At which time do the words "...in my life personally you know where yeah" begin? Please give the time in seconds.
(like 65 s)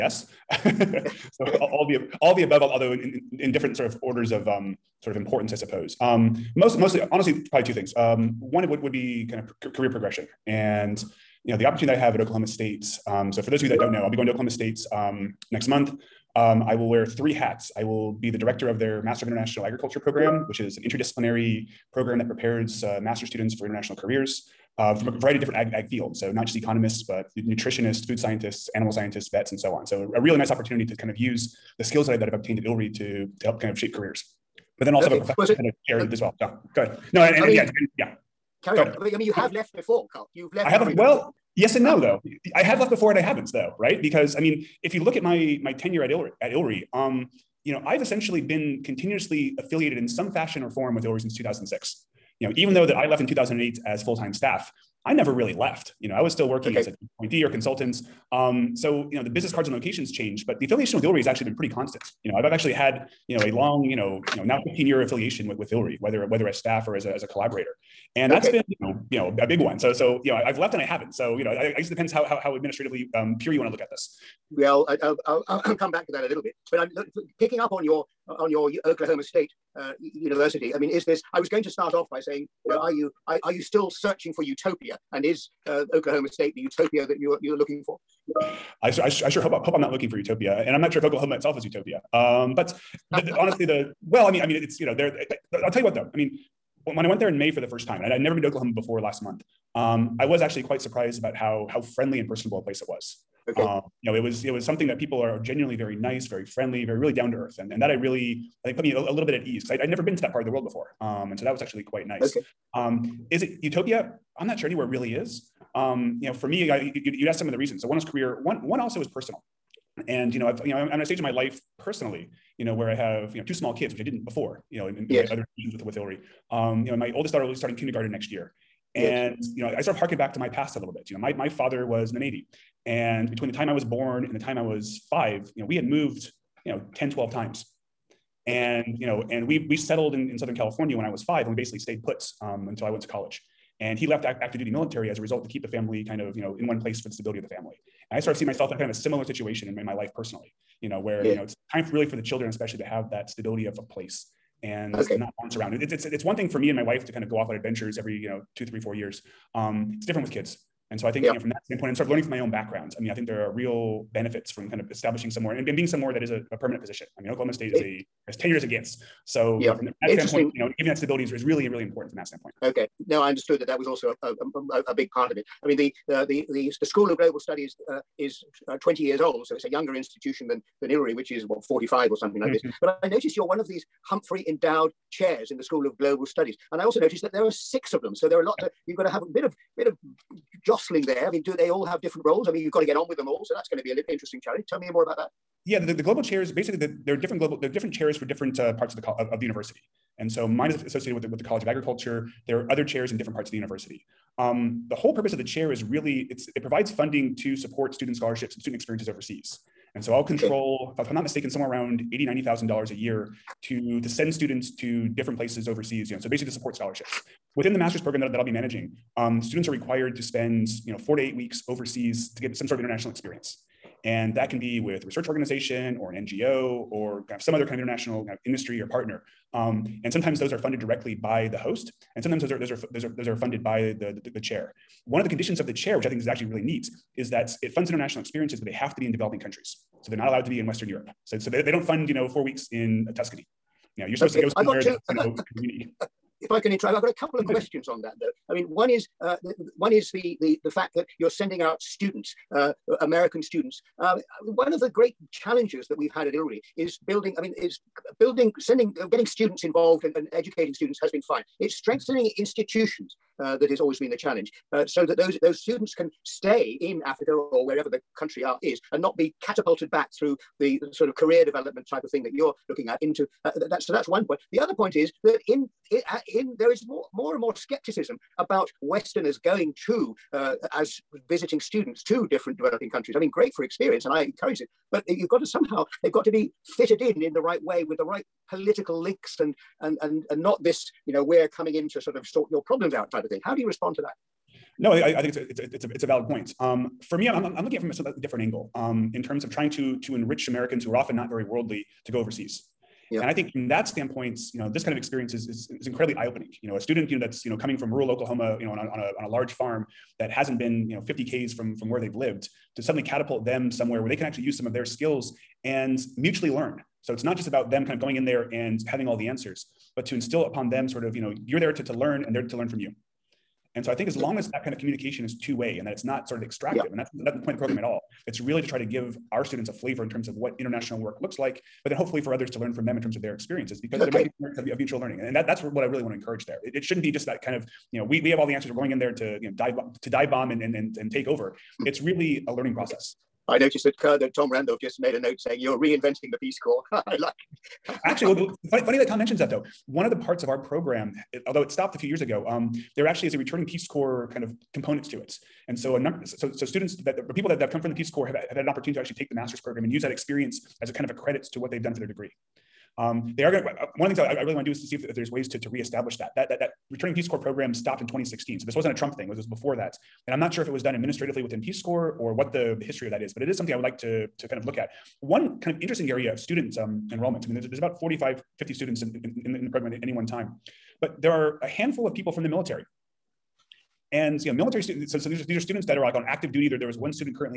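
149 s.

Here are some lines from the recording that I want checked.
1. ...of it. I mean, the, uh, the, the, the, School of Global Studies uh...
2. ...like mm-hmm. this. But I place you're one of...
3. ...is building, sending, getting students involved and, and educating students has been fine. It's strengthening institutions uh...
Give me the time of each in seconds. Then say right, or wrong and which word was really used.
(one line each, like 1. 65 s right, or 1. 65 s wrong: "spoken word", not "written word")
1. 175 s right
2. 182 s wrong: "notice", not "place"
3. 257 s right.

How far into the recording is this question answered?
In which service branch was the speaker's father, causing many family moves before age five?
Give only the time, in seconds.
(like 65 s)
132 s.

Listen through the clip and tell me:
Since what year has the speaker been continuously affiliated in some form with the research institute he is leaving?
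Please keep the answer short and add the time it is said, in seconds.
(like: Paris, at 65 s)
2006, at 51 s.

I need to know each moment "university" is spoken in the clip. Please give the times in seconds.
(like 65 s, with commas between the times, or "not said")
79 s, 199 s, 203 s.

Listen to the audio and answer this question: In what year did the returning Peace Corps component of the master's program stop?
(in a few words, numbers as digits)
2016.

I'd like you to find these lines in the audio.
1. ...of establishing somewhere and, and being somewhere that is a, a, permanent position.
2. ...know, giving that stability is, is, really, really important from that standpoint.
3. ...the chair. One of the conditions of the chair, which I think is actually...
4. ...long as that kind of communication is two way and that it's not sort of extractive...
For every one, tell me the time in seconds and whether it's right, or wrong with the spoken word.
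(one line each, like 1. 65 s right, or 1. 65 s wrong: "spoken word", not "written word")
1. 164 s right
2. 170 s right
3. 234 s right
4. 324 s right.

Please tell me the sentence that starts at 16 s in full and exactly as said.
Um, I will wear three hats.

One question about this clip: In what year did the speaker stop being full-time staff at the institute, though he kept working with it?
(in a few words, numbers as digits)
2008.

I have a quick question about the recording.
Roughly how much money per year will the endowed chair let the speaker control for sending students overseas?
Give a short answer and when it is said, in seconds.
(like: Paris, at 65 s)
$80,000-90,000, at 212 s.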